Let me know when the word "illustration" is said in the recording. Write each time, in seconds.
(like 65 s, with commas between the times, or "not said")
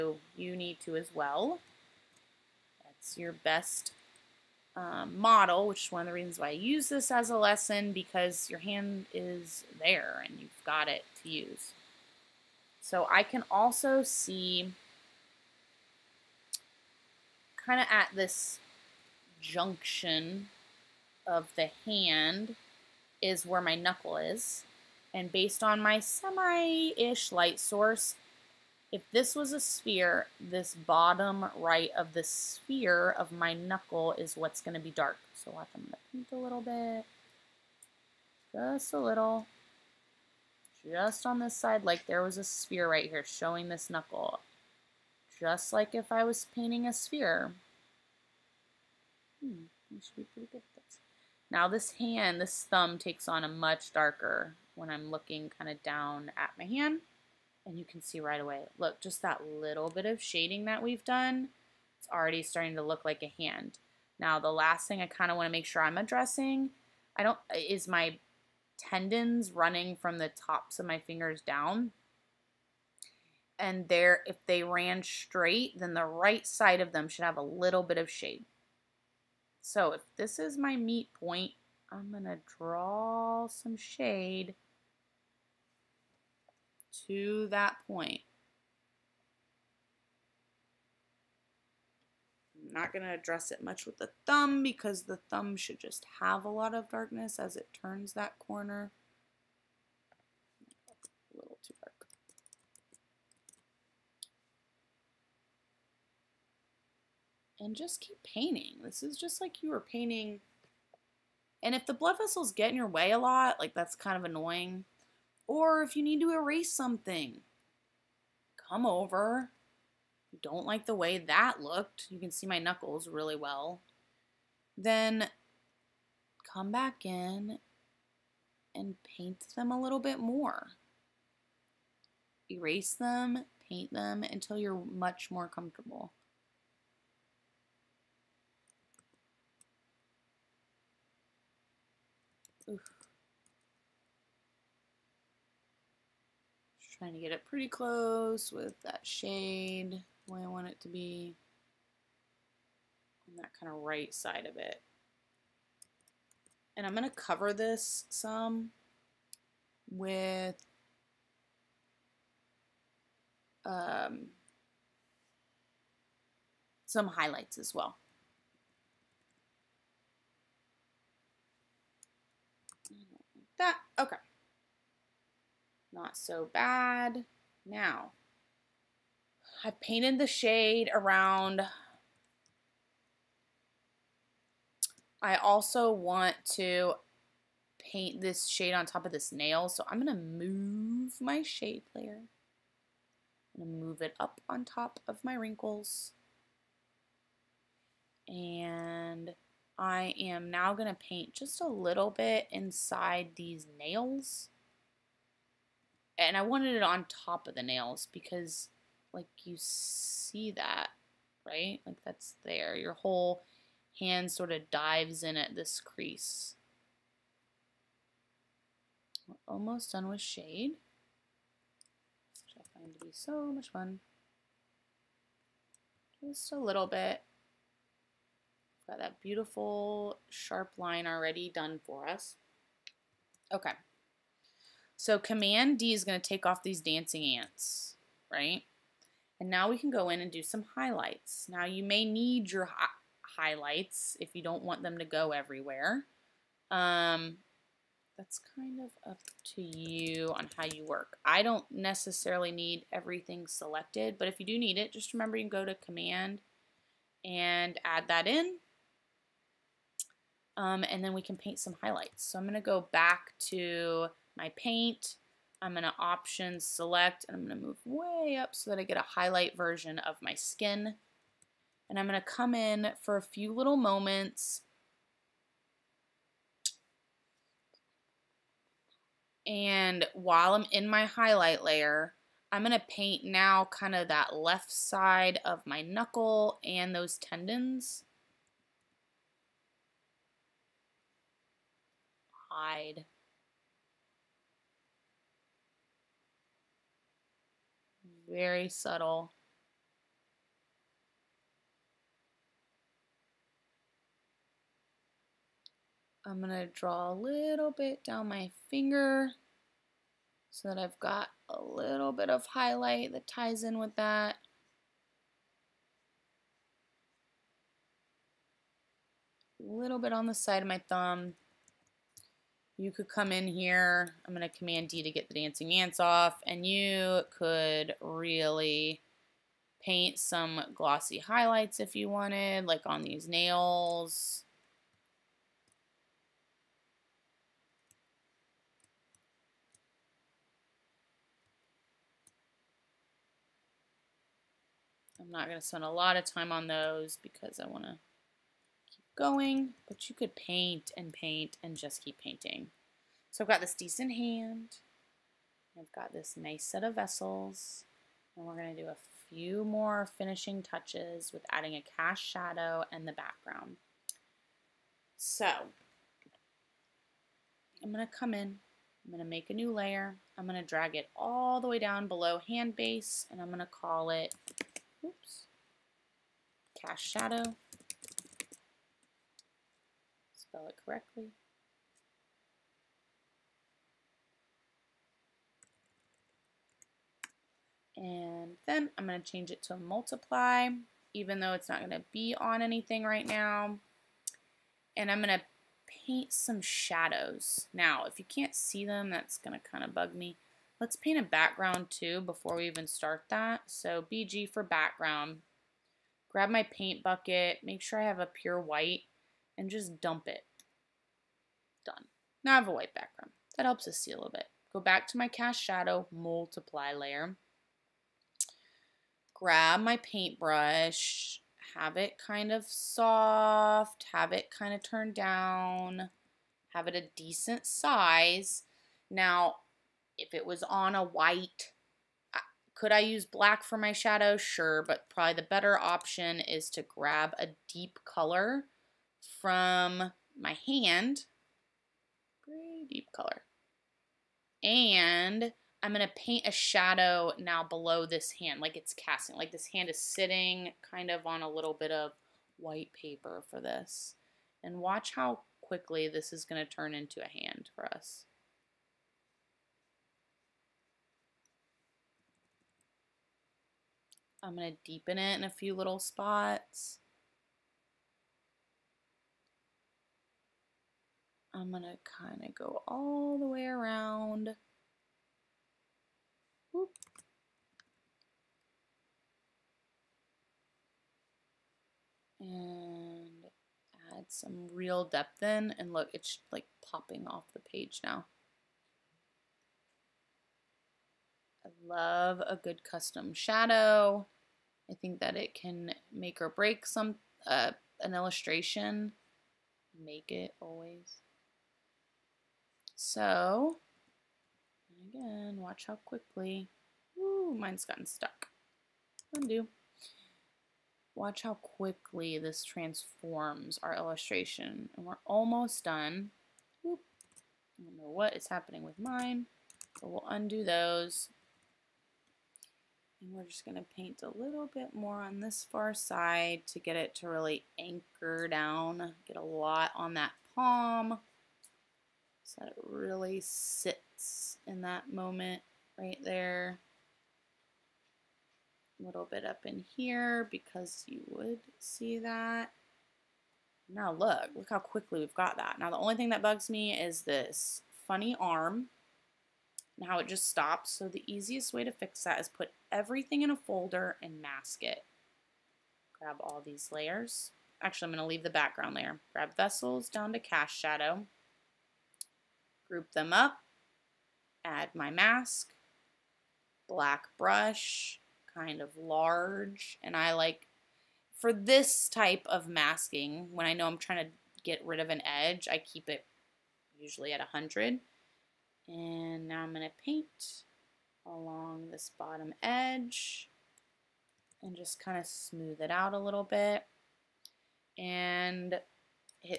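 498 s, 513 s.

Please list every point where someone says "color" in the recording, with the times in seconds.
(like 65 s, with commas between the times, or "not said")
438 s, 443 s.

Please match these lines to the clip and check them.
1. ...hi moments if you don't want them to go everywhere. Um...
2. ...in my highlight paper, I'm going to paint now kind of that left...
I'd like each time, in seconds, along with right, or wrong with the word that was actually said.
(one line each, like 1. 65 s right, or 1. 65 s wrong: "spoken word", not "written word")
1. 242 s wrong: "highlights", not "moments"
2. 280 s wrong: "layer", not "paper".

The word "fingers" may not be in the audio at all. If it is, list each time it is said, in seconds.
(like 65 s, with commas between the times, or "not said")
70 s, 308 s.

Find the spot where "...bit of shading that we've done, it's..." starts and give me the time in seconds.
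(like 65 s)
59 s.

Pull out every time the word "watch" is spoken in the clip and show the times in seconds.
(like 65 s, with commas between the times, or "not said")
35 s, 454 s, 505 s, 511 s.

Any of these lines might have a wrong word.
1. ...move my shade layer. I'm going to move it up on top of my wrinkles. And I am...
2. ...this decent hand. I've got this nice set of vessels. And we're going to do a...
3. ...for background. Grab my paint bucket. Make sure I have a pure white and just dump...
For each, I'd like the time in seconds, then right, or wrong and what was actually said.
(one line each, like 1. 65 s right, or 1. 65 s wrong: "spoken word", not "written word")
1. 190 s right
2. 353 s right
3. 404 s right.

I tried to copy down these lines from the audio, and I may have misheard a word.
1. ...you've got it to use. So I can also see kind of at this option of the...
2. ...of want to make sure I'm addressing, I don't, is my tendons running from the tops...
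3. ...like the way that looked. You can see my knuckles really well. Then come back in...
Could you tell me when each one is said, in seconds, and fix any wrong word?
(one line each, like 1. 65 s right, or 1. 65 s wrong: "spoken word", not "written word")
1. 10 s wrong: "junction", not "option"
2. 65 s right
3. 120 s right.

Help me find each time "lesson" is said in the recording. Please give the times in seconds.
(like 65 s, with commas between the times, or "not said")
7 s.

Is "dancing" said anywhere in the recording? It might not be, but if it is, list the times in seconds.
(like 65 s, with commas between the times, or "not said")
236 s, 325 s.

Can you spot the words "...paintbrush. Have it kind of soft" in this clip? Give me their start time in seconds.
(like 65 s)
419 s.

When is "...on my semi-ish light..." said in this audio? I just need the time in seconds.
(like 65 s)
25 s.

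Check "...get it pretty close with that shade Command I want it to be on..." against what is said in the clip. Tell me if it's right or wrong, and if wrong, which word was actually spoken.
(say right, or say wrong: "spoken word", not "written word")
wrong: "Way", not "Command".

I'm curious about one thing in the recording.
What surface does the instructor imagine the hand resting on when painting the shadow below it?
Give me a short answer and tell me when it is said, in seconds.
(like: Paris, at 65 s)
White paper, at 452 s.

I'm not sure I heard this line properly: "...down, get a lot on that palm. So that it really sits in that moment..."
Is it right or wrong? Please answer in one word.
right.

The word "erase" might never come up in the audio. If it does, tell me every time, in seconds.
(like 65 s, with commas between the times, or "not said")
116 s, 132 s.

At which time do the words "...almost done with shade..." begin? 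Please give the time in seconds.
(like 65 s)
219 s.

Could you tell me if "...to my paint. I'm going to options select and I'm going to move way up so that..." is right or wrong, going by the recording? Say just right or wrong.
right.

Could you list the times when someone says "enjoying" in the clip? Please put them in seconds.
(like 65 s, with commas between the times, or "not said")
not said.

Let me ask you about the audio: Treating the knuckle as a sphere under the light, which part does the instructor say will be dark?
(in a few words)
Bottom right.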